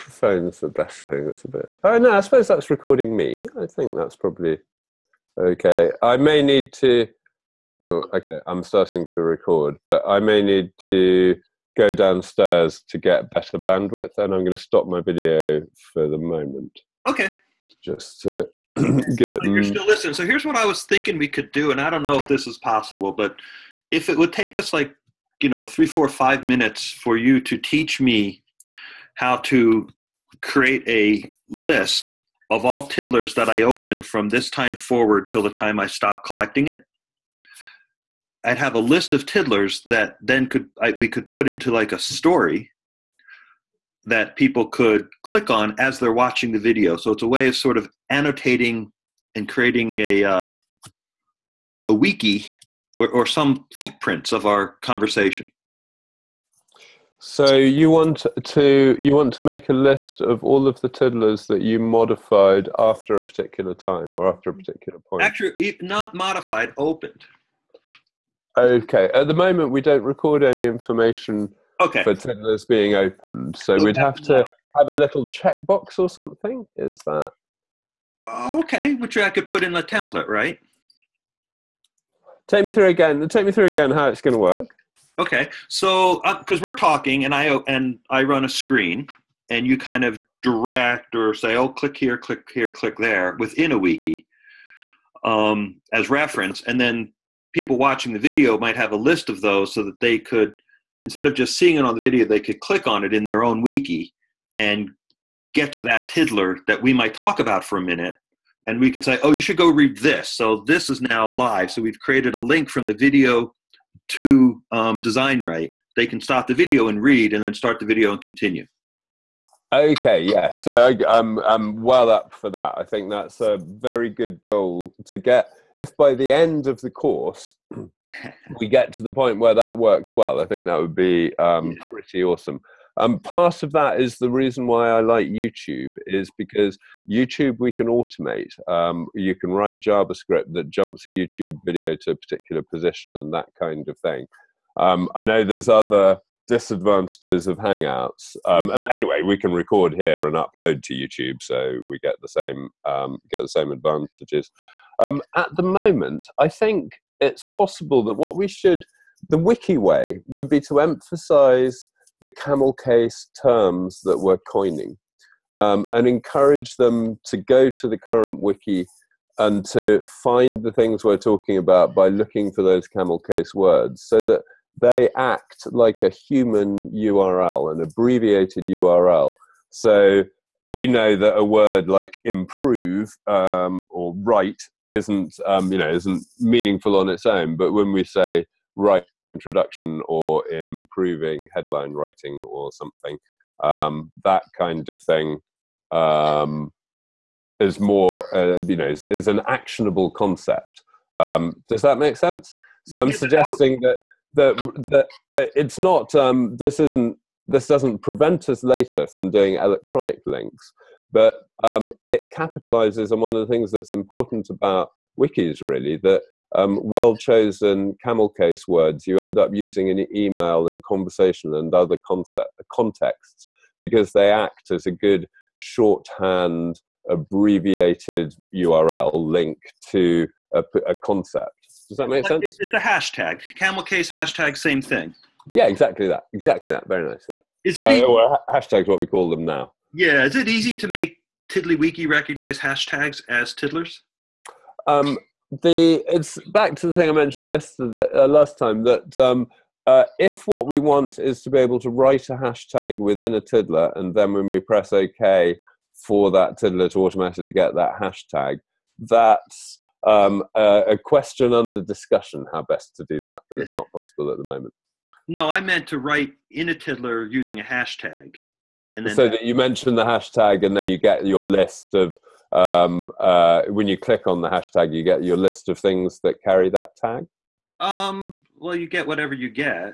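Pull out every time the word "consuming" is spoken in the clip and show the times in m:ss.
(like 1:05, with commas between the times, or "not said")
not said.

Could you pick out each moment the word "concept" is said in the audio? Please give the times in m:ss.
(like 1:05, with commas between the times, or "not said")
3:20, 3:42, 3:50.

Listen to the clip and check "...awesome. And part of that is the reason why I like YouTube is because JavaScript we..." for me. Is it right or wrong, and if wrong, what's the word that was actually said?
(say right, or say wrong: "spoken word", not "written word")
wrong: "YouTube", not "JavaScript".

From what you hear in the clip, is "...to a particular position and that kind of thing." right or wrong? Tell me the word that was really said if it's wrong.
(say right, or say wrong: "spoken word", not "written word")
right.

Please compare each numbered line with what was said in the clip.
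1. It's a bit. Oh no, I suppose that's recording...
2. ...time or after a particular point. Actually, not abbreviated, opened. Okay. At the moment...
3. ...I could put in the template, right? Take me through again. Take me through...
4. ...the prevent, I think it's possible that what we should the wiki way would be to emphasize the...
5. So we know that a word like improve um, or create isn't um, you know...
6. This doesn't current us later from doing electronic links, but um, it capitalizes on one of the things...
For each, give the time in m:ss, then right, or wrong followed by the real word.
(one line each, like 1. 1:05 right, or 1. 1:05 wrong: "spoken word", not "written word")
1. 0:01 right
2. 1:03 wrong: "modified", not "abbreviated"
3. 1:19 right
4. 2:35 wrong: "moment", not "prevent"
5. 2:59 wrong: "write", not "create"
6. 3:27 wrong: "prevent", not "current".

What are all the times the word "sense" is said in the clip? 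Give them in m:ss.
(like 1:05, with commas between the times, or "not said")
3:22, 3:52.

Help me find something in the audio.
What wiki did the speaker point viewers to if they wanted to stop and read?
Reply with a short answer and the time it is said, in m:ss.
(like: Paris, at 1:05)
DesignWrite, at 1:55.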